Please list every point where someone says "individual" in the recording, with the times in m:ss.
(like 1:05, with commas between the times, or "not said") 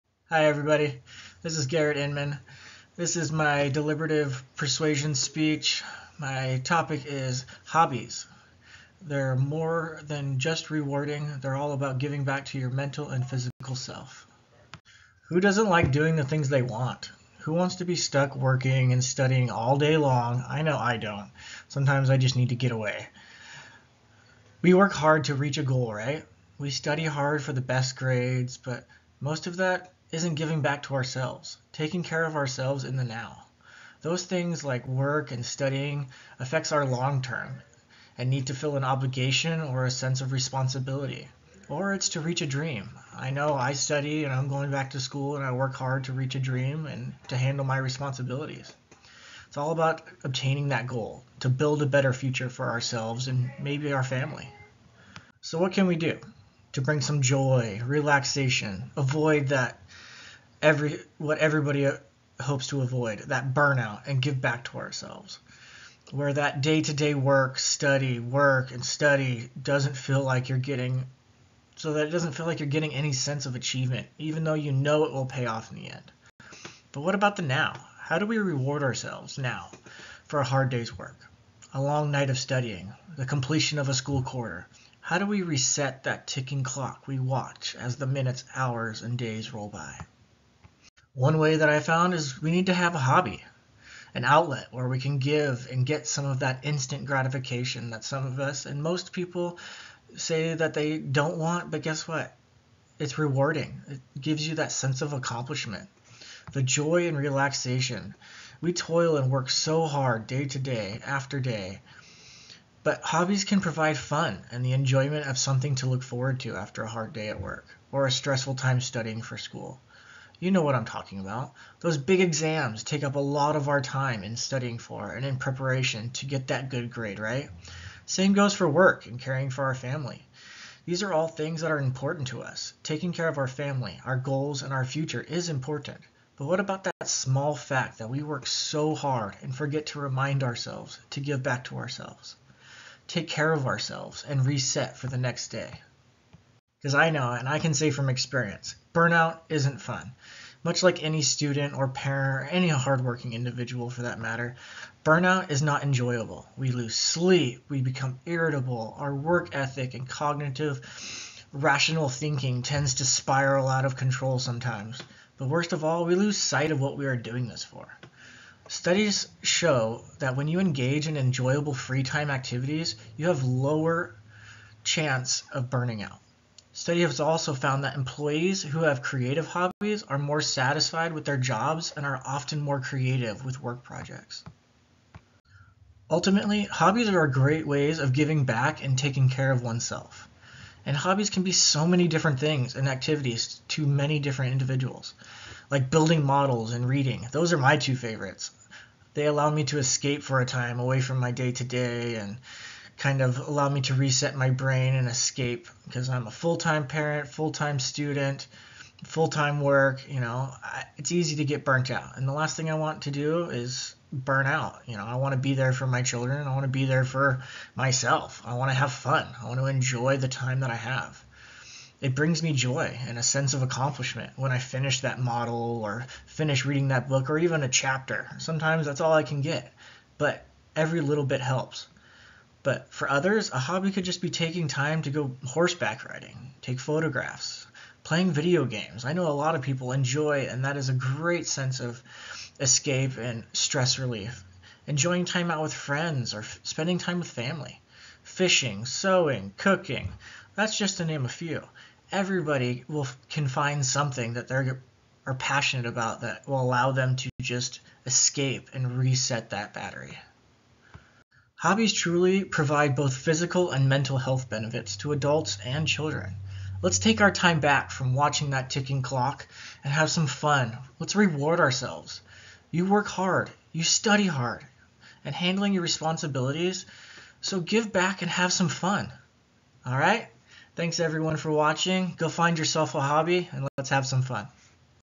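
2:33, 3:14.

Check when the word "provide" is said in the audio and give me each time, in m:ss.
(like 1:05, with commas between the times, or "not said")
1:53, 4:22.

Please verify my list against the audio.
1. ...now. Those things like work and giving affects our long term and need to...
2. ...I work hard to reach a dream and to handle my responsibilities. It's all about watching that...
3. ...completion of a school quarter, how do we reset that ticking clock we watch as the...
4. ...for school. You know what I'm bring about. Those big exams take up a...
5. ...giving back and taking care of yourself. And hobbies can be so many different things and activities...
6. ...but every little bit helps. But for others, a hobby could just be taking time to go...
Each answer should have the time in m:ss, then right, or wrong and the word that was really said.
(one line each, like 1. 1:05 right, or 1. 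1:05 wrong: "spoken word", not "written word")
1. 0:33 wrong: "studying", not "giving"
2. 0:45 wrong: "obtaining", not "watching"
3. 1:23 right
4. 1:59 wrong: "talking", not "bring"
5. 3:08 wrong: "oneself", not "yourself"
6. 3:50 right.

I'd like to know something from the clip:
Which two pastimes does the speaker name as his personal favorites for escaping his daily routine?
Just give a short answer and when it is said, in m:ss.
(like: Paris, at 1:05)
Building models and reading, at 3:15.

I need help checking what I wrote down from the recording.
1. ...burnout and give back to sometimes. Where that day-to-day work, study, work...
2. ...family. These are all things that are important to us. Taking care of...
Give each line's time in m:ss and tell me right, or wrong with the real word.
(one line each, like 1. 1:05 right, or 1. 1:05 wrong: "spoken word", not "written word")
1. 1:03 wrong: "ourselves", not "sometimes"
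2. 2:09 right.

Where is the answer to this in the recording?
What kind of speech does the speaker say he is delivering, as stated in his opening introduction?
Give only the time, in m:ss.
0:03.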